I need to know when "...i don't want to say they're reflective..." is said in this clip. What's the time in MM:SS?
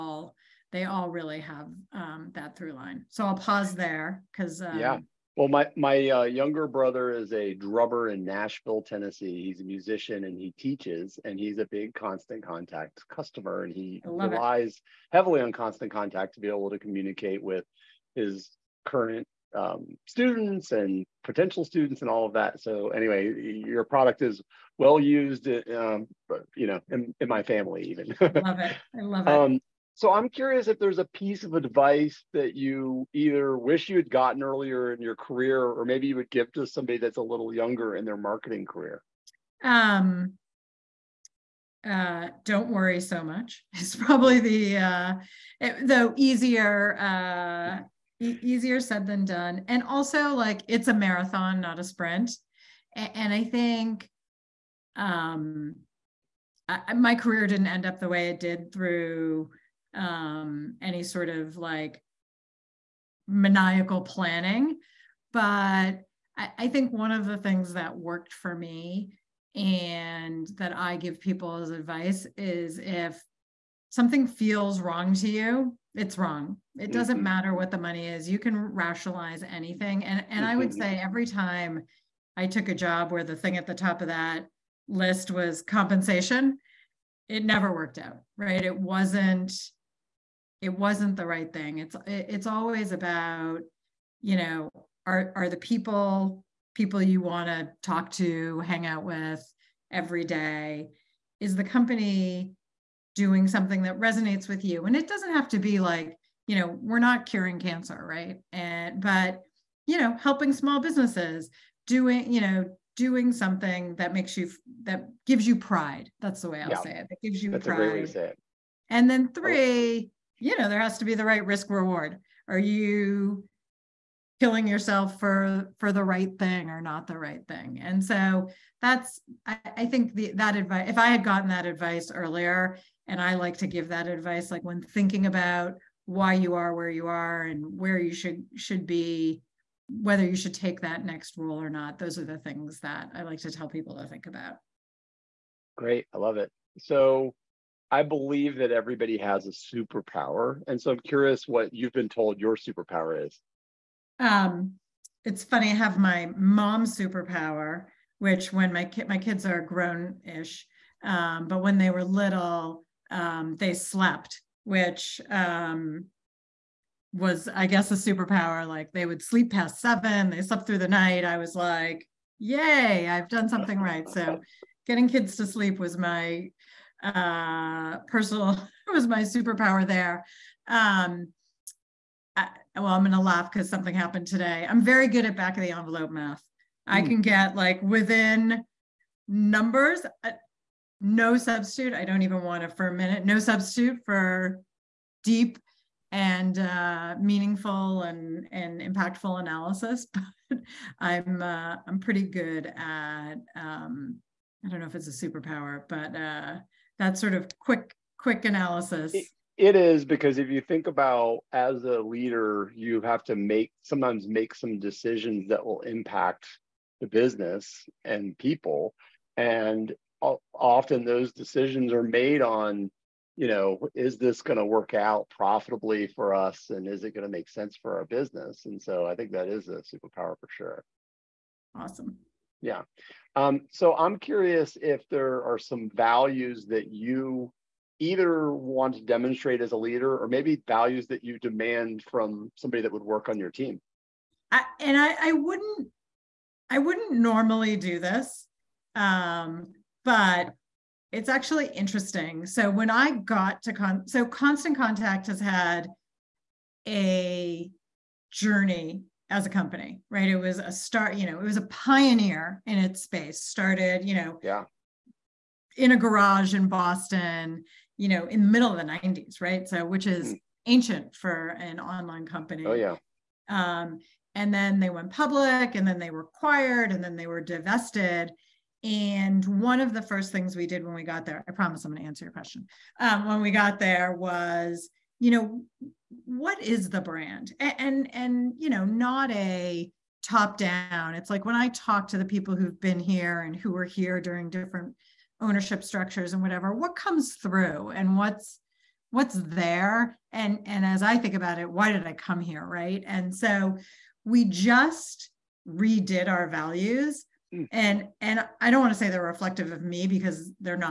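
05:08.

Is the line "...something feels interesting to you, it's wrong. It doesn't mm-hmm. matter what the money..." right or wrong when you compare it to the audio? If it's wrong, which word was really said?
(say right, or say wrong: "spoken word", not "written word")
wrong: "wrong", not "interesting".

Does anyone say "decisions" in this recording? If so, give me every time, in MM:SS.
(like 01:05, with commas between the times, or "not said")
03:34, 03:41.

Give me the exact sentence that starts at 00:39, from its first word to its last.
Um, uh, don't worry so much.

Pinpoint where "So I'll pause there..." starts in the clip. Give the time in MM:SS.
00:03.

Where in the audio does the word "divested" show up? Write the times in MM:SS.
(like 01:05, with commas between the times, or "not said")
04:37.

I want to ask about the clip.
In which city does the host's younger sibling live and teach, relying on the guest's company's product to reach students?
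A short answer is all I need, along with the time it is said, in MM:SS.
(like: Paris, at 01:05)
Nashville, Tennessee, at 00:08.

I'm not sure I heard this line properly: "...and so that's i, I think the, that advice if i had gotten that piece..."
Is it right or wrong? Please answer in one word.
wrong.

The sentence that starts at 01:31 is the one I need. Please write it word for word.
It's it's always about, you know, are are the people people you want to talk to, hang out with every day?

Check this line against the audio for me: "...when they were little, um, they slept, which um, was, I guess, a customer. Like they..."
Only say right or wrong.
wrong.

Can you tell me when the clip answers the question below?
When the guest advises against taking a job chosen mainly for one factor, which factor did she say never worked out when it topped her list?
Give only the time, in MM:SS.
01:25.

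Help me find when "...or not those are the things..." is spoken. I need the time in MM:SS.
02:21.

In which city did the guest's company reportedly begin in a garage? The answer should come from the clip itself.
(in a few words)
Boston.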